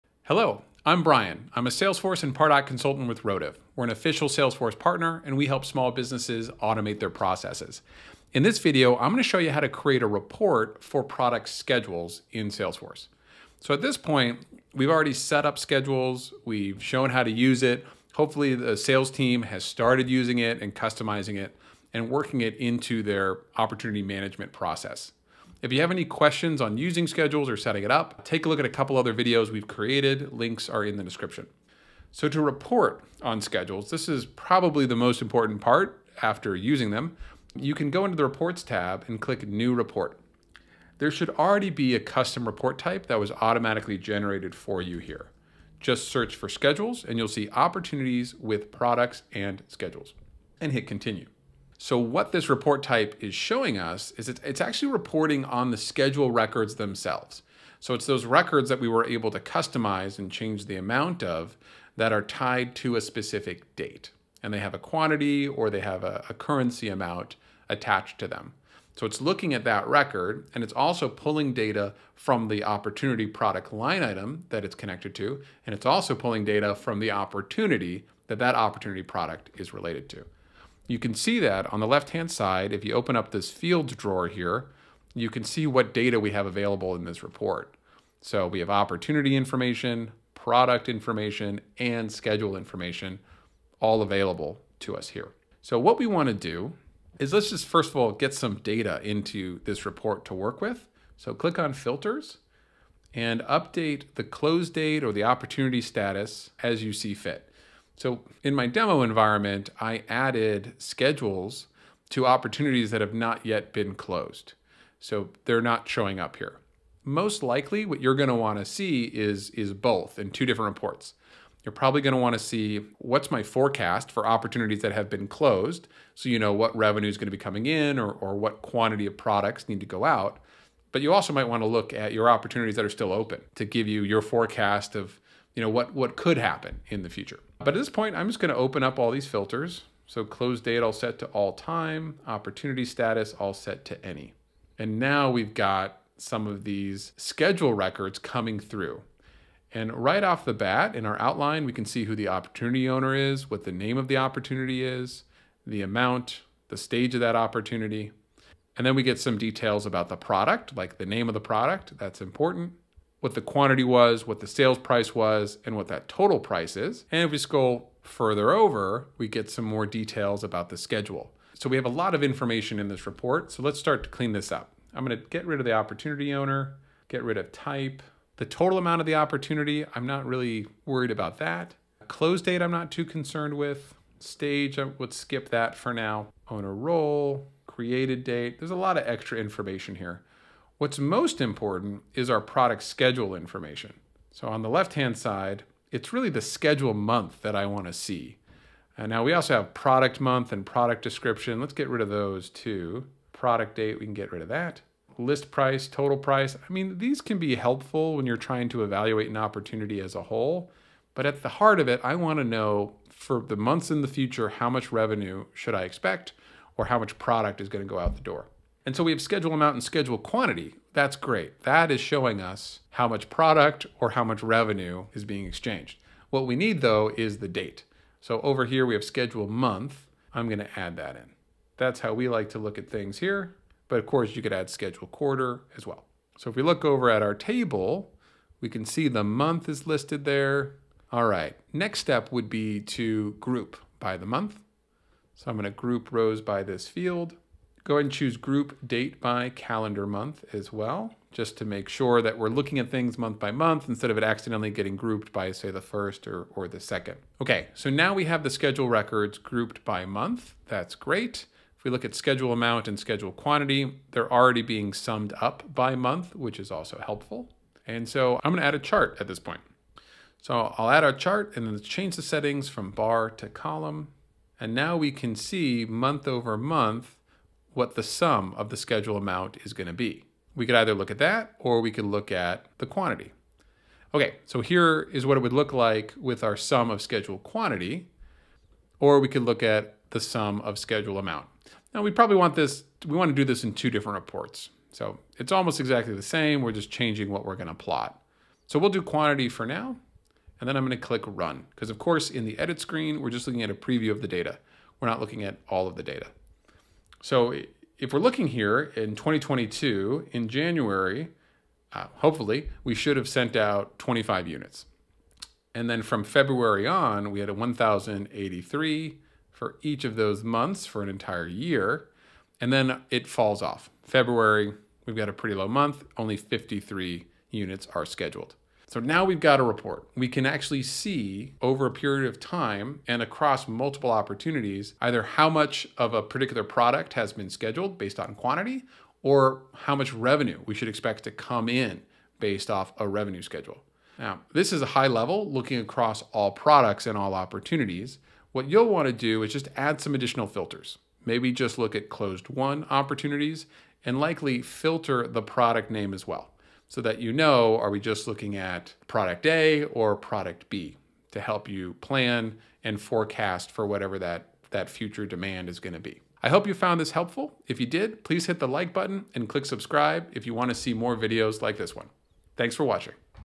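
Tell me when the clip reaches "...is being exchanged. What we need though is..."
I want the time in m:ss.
3:45.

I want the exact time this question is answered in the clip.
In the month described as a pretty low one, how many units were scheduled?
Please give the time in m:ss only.
5:26.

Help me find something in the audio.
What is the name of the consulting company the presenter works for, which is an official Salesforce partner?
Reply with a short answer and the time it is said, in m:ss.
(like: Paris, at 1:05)
Rotive, at 0:03.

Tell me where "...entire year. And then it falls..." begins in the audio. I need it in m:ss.
5:21.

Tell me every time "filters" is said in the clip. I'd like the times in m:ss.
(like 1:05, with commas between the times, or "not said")
1:41, 2:19, 5:50, 5:54.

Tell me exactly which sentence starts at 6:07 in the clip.
If you did, please hit the like button and click subscribe if you want to see more videos like this one.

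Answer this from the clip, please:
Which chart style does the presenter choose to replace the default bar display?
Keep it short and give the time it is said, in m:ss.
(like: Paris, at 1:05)
column, at 4:33.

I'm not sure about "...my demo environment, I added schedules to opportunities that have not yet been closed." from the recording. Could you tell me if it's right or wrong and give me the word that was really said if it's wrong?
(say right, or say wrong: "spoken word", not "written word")
right.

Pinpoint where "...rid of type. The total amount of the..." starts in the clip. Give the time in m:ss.
2:57.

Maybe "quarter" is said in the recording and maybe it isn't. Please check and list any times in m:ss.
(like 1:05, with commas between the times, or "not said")
3:55.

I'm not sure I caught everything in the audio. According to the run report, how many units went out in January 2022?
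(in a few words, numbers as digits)
25.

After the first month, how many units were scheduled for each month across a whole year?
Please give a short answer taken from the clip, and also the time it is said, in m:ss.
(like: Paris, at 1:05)
1,083, at 5:17.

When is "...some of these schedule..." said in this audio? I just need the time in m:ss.
2:26.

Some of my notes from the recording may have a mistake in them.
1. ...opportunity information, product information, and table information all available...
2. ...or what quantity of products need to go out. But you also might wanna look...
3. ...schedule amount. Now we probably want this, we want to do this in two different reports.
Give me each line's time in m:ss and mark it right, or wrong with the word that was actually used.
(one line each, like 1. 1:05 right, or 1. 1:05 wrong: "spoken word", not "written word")
1. 1:28 wrong: "schedule", not "table"
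2. 2:08 right
3. 4:50 right.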